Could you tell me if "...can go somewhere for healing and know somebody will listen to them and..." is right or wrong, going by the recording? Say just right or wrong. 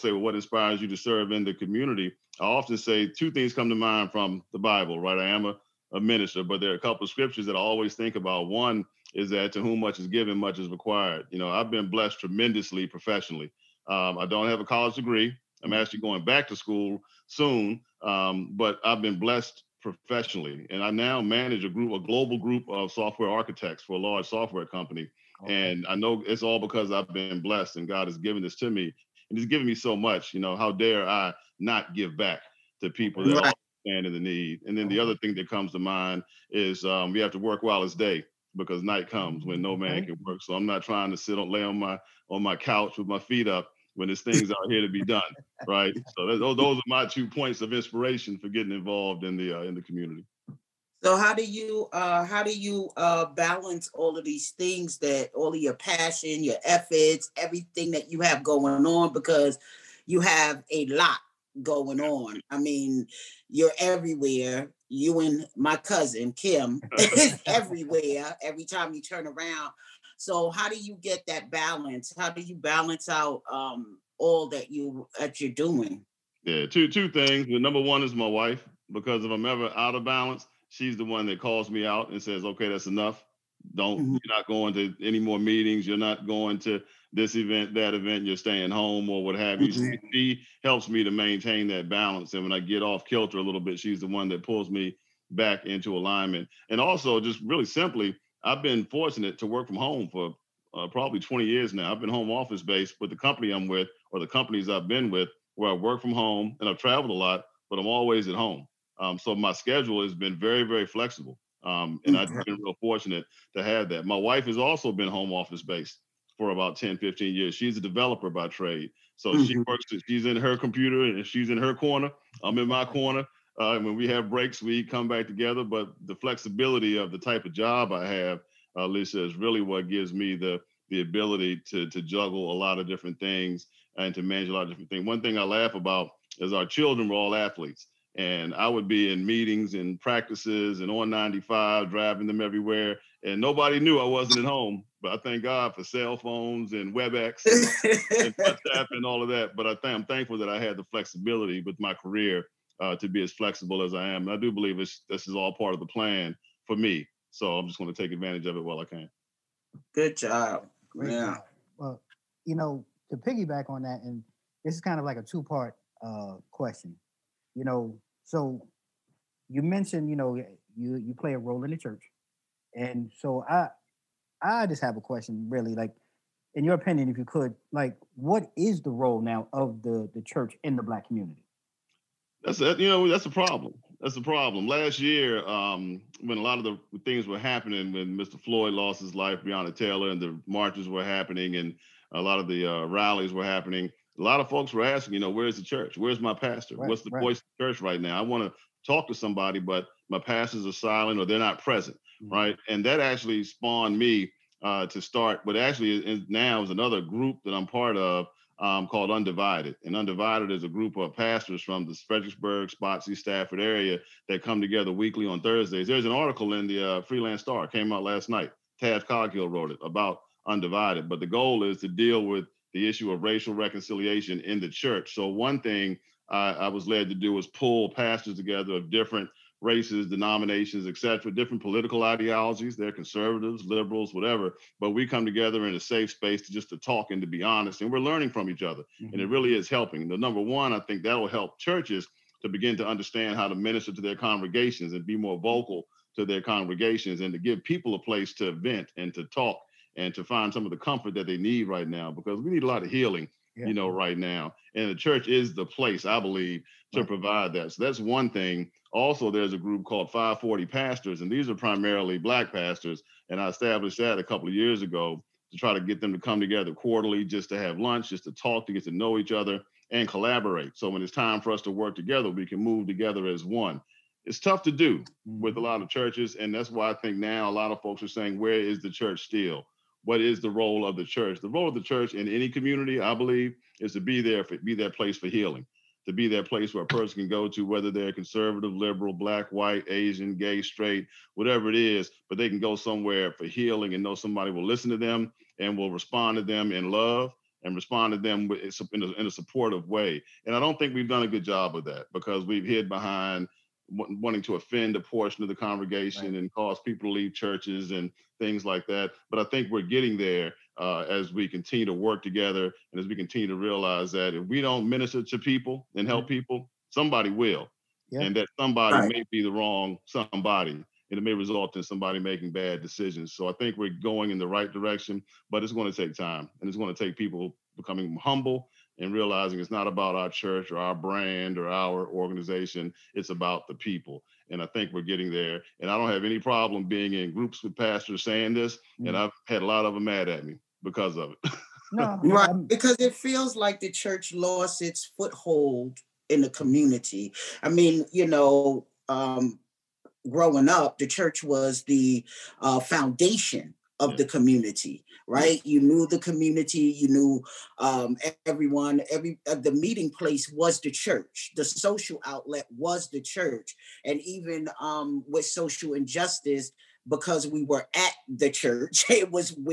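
right.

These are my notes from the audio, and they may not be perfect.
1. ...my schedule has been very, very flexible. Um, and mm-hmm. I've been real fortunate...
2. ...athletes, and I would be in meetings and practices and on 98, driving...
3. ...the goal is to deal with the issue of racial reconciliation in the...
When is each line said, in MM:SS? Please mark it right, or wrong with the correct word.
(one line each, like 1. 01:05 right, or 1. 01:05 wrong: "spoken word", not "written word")
1. 01:49 right
2. 02:17 wrong: "95", not "98"
3. 03:41 right.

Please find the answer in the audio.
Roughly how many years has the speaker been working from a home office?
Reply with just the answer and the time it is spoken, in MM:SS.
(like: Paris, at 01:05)
20 years, at 01:41.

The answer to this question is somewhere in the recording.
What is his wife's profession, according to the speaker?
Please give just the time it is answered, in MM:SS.
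01:57.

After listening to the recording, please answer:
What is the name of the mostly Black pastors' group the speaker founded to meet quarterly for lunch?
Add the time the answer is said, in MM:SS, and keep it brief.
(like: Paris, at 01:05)
540 Pastors, at 04:20.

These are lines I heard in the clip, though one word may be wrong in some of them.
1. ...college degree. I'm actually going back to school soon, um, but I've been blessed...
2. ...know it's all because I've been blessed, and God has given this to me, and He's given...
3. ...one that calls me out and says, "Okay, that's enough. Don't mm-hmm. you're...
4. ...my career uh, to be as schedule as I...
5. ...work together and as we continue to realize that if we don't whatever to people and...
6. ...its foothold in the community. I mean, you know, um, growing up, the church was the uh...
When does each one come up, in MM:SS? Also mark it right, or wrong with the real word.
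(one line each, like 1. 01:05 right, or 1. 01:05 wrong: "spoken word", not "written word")
1. 00:14 right
2. 00:25 right
3. 01:21 right
4. 02:31 wrong: "flexible", not "schedule"
5. 05:11 wrong: "minister", not "whatever"
6. 05:44 right.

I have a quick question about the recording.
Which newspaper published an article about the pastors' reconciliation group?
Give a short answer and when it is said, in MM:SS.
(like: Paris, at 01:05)
Free Lance-Star, at 03:37.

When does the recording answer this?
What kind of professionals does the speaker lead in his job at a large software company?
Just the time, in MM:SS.
00:22.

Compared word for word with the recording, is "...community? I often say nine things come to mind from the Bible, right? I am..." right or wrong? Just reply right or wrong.
wrong.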